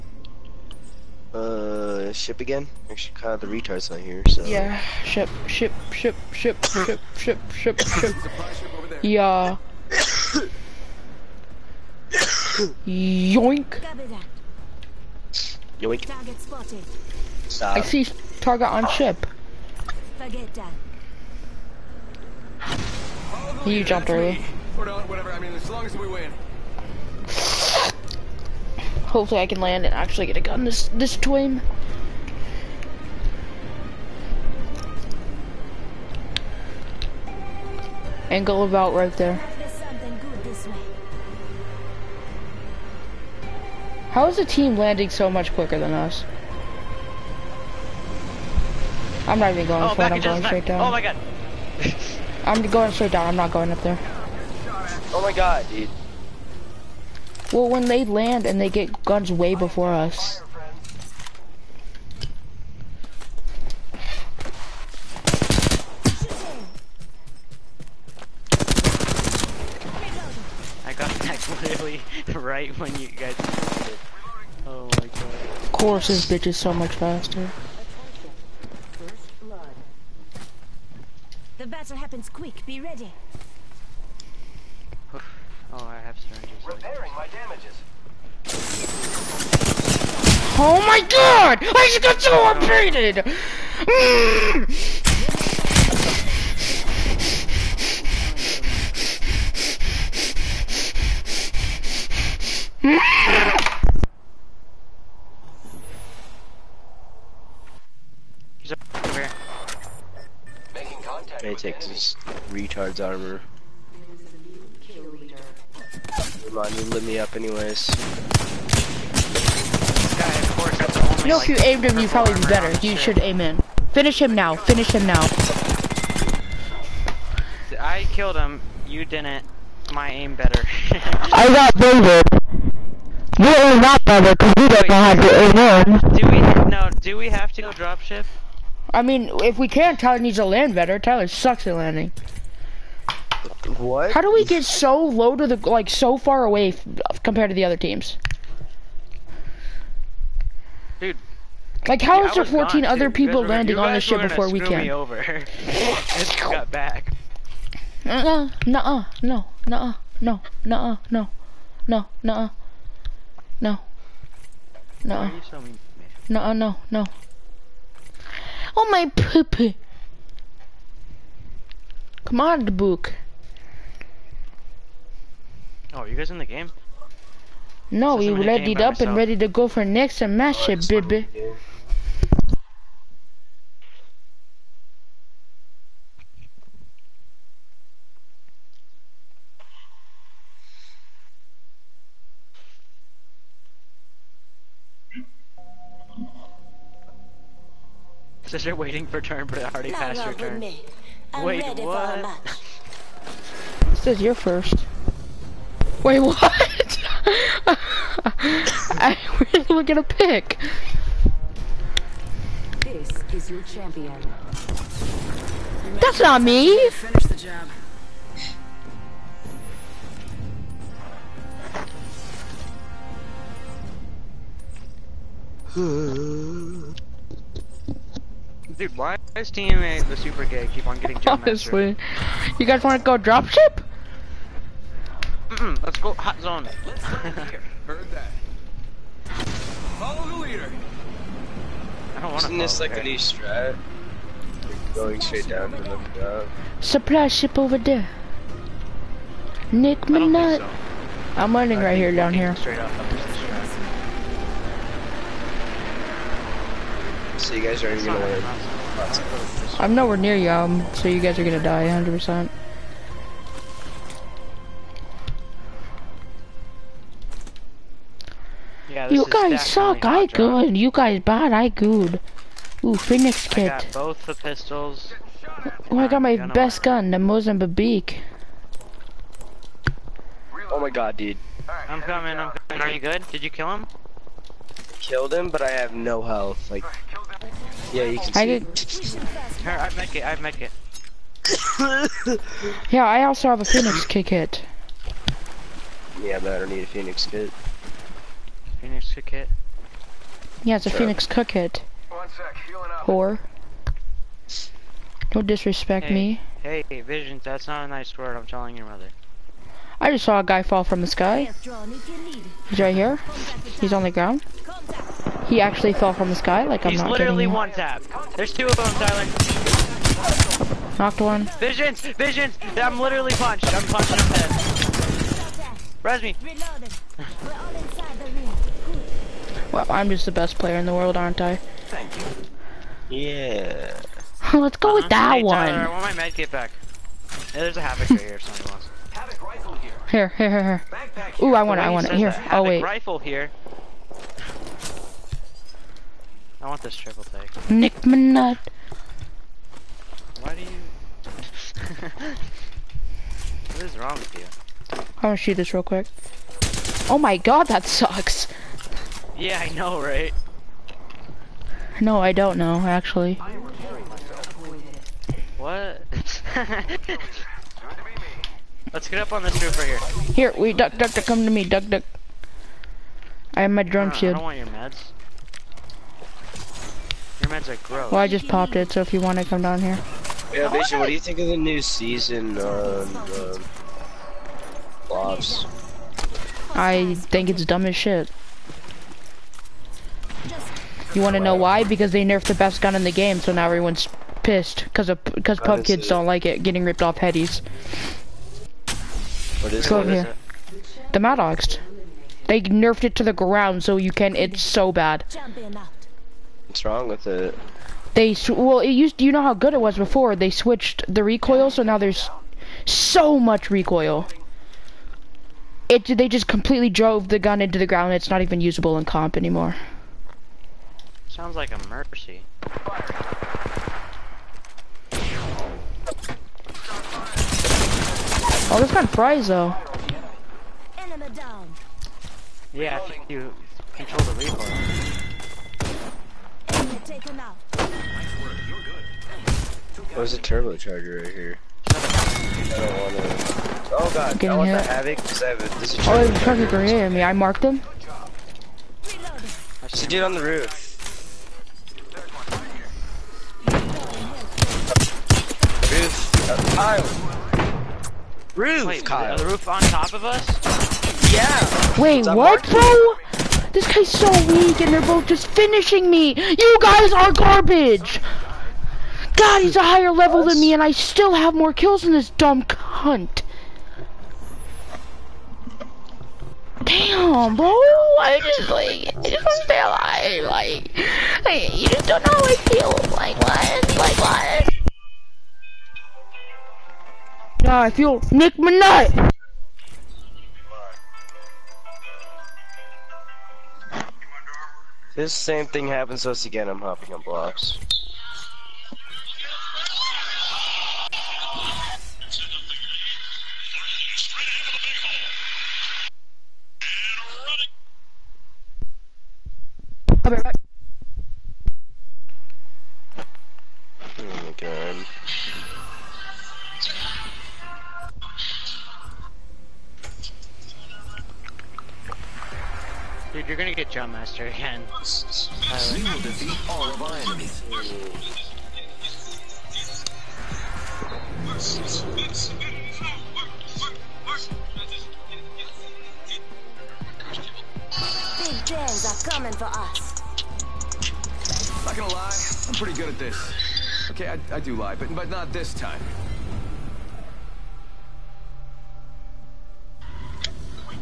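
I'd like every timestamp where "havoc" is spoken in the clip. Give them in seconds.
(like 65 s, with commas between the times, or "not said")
337 s, 444 s.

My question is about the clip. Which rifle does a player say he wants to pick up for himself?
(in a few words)
Triple Take.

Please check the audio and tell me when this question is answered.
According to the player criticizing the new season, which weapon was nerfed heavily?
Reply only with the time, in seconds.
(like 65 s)
401 s.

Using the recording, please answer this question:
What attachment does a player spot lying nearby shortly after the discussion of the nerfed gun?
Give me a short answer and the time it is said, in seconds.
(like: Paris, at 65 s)
Turbocharger, at 440 s.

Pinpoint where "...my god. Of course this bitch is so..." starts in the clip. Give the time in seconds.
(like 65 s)
74 s.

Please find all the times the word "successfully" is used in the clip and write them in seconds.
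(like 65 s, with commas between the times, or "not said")
not said.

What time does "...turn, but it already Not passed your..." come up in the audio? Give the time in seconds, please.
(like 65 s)
199 s.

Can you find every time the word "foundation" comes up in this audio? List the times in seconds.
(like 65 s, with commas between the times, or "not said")
not said.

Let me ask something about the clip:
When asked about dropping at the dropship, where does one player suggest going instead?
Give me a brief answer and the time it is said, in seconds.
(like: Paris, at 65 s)
Hot zone, at 235 s.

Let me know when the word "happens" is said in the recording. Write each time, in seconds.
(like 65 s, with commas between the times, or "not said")
81 s, 495 s.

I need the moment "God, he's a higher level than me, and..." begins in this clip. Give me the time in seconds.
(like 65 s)
469 s.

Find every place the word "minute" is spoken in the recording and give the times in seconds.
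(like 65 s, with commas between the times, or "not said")
250 s, 348 s.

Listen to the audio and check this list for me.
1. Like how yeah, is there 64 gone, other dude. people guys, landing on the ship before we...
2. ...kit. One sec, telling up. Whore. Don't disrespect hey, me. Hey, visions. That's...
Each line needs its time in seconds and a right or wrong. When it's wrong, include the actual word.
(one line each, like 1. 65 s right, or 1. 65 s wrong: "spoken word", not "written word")
1. 151 s wrong: "14", not "64"
2. 301 s wrong: "healing", not "telling".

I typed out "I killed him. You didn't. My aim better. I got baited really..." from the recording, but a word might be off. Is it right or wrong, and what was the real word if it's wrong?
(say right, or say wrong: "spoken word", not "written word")
right.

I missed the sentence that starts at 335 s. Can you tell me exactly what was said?
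Tyler, I want my med kit back.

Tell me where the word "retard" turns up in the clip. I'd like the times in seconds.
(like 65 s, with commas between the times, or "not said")
3 s, 112 s.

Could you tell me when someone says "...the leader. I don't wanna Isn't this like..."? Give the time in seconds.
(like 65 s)
240 s.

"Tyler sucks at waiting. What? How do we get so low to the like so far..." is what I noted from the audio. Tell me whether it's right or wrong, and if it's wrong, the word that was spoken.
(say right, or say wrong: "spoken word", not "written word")
wrong: "landing", not "waiting".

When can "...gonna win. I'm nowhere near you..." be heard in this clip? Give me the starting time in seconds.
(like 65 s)
258 s.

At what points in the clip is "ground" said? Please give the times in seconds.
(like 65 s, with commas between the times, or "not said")
314 s, 403 s, 417 s.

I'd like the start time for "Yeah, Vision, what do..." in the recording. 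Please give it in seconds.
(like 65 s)
380 s.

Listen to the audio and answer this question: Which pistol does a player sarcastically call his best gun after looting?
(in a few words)
Mozambique.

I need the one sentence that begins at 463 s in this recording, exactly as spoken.
This guy's so weak, and they're both just finishing me.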